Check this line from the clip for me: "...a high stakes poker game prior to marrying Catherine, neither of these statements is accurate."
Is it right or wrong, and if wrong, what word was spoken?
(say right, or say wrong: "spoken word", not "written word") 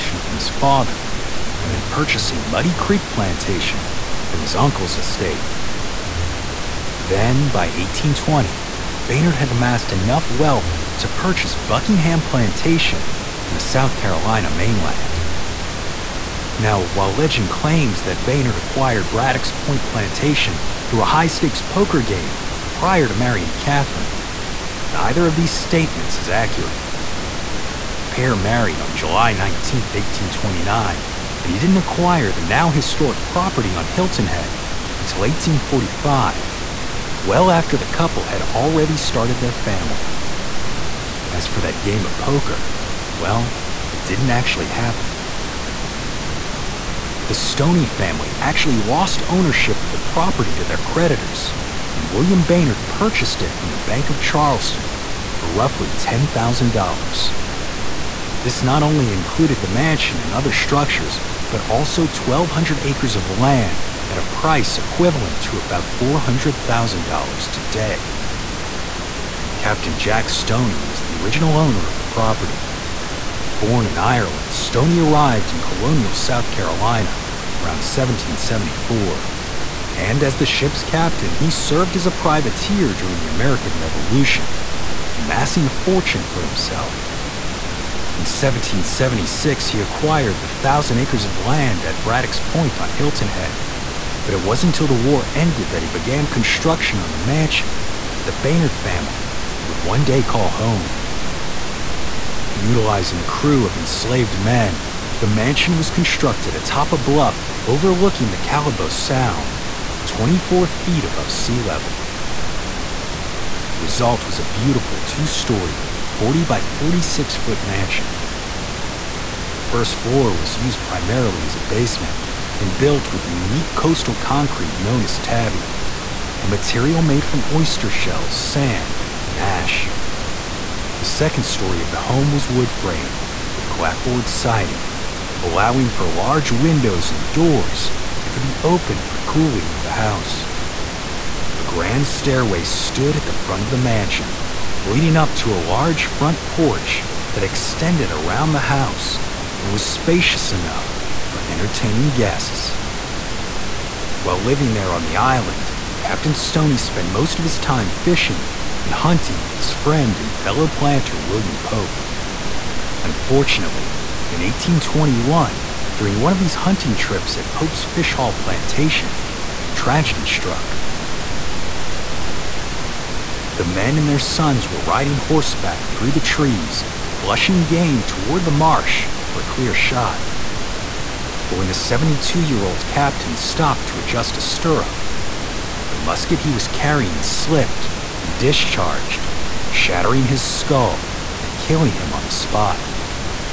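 right.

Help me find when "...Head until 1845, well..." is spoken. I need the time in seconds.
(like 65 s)
34 s.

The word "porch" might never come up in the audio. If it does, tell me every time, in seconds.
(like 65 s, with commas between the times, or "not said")
146 s.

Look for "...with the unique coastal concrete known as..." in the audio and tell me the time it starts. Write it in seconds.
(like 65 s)
123 s.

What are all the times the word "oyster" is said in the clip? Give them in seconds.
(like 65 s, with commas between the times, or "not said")
127 s.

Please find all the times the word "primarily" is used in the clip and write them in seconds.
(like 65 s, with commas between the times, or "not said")
120 s.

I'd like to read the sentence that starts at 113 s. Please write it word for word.
The result was a beautiful two story, 40 by 46 foot mansion.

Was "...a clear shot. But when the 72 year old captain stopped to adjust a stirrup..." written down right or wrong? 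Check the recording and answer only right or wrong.
right.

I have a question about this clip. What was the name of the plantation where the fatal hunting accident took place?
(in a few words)
Fish Haul.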